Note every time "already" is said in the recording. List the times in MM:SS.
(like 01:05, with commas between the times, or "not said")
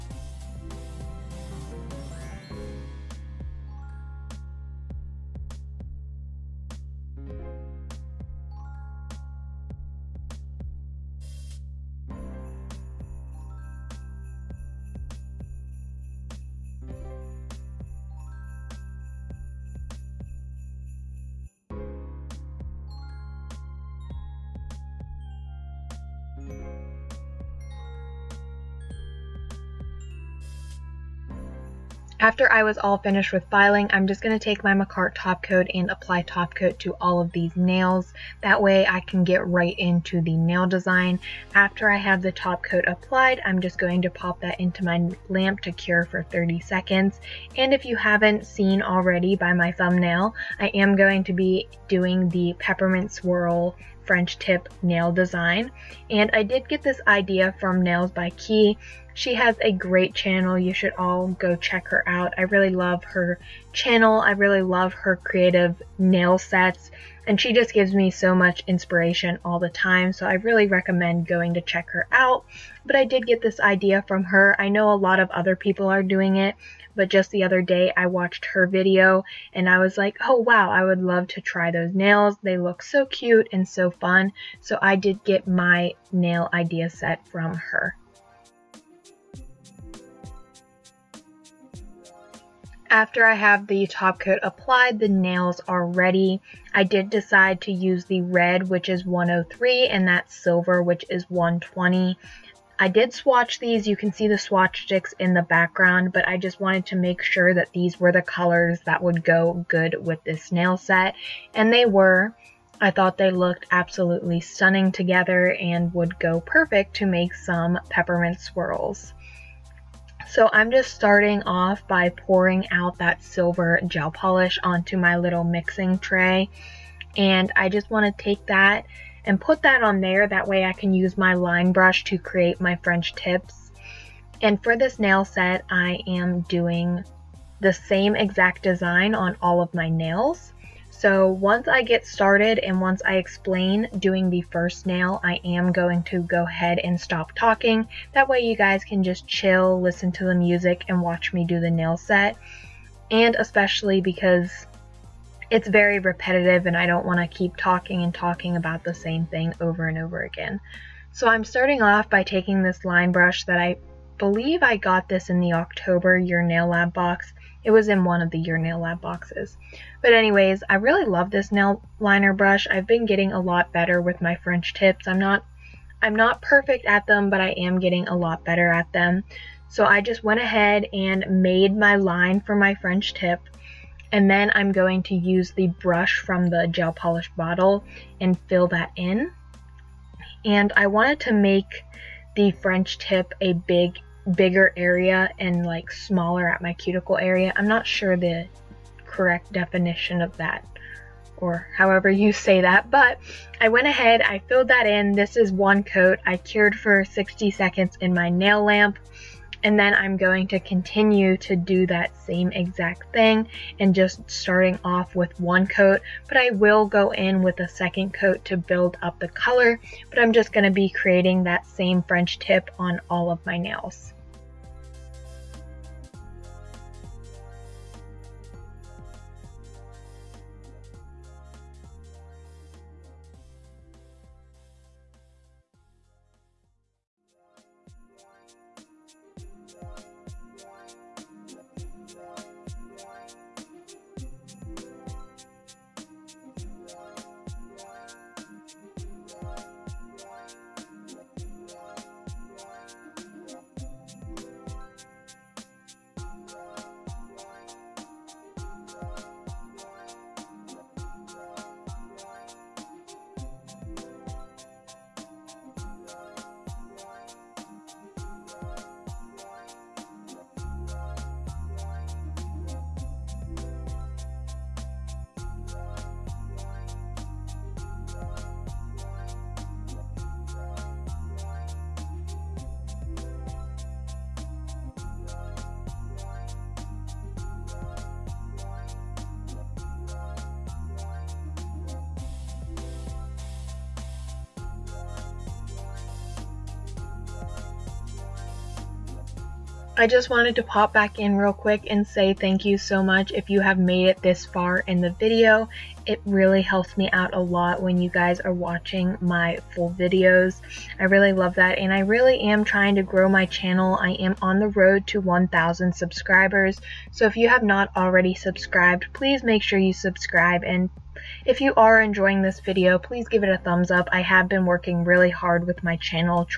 00:48, 05:17.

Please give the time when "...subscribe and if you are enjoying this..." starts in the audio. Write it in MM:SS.
05:19.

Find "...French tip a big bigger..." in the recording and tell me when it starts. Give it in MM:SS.
03:12.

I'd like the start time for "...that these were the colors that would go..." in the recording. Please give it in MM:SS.
01:47.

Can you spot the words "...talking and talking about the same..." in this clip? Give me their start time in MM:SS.
02:37.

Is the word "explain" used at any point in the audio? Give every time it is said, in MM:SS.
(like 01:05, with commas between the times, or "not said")
02:23.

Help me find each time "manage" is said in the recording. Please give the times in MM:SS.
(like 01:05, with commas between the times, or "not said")
not said.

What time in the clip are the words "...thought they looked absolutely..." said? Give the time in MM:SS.
01:52.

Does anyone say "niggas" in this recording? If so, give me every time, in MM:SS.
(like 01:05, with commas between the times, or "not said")
not said.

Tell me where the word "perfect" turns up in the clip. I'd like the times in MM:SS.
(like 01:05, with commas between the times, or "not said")
01:56, 02:56.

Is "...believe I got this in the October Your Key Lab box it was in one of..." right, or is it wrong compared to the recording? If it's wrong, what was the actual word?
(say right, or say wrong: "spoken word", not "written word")
wrong: "Nail", not "Key".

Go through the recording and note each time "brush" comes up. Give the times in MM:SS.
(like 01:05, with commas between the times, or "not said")
02:11, 02:43, 02:52, 03:05.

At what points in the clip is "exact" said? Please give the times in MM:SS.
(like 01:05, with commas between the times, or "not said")
02:18, 03:32.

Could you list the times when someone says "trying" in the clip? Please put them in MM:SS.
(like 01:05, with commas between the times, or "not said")
05:12.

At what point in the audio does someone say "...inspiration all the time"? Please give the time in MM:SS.
01:08.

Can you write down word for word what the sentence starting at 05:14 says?
I am on the road to 1,000 subscribers.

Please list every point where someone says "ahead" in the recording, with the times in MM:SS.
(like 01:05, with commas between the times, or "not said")
02:26, 03:00, 03:23.